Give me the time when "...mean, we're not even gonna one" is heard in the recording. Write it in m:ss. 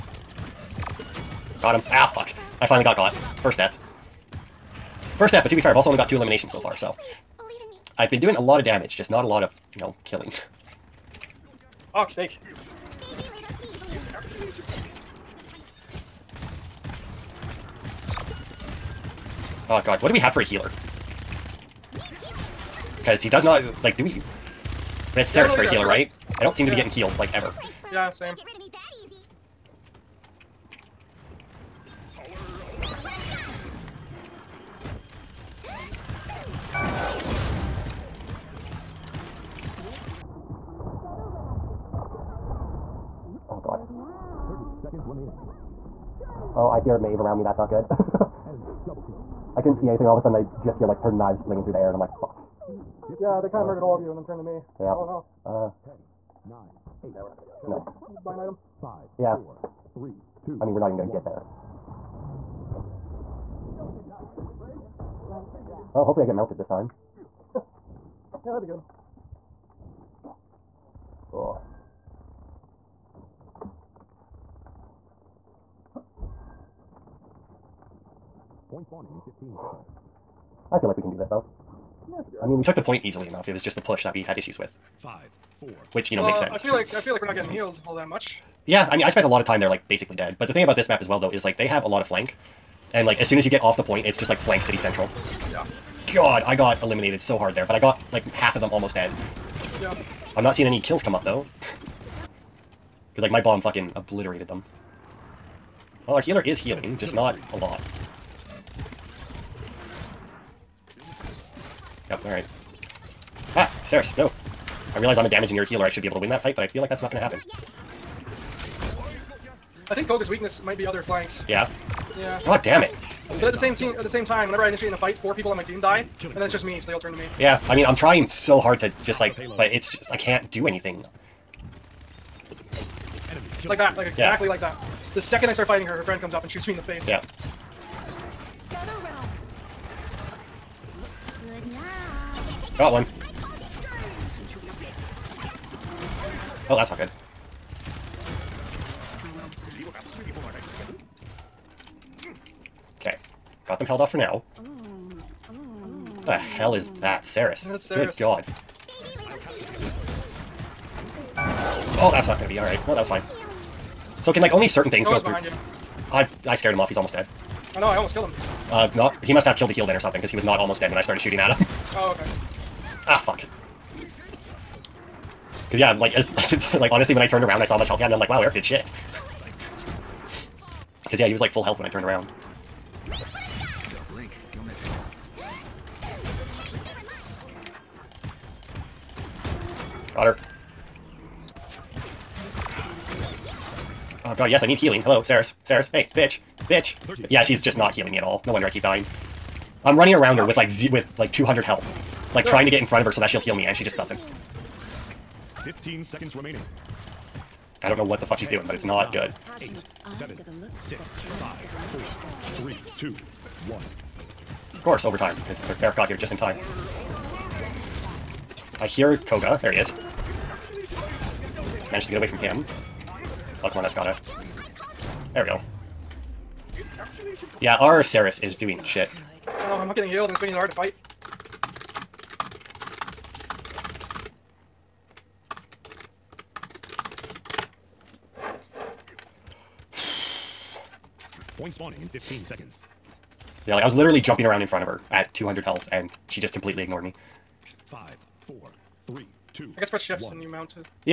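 1:00.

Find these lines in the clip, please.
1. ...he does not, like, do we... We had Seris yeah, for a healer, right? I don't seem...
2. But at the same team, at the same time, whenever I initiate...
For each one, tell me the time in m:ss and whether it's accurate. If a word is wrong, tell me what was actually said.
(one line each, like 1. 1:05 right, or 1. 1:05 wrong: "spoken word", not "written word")
1. 0:23 right
2. 2:03 right.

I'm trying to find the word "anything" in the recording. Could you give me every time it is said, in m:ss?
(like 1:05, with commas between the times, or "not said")
0:49, 2:10.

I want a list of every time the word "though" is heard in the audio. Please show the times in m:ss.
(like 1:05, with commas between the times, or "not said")
1:21, 1:31, 1:41.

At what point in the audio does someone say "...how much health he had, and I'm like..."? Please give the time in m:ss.
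2:57.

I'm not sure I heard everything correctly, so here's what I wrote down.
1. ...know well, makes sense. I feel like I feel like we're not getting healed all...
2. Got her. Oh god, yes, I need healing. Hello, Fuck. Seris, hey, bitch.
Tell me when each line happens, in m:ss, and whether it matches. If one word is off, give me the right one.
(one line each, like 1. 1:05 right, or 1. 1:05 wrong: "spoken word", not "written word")
1. 1:26 right
2. 3:10 wrong: "Seris", not "Fuck".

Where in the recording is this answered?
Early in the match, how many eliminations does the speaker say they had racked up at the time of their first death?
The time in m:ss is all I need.
0:06.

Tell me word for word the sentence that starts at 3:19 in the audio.
I'm running around her with like with like 200 health.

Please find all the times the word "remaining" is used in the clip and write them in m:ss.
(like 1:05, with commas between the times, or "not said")
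0:45, 3:26.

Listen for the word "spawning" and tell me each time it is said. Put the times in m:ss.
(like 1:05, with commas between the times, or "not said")
1:18, 4:01.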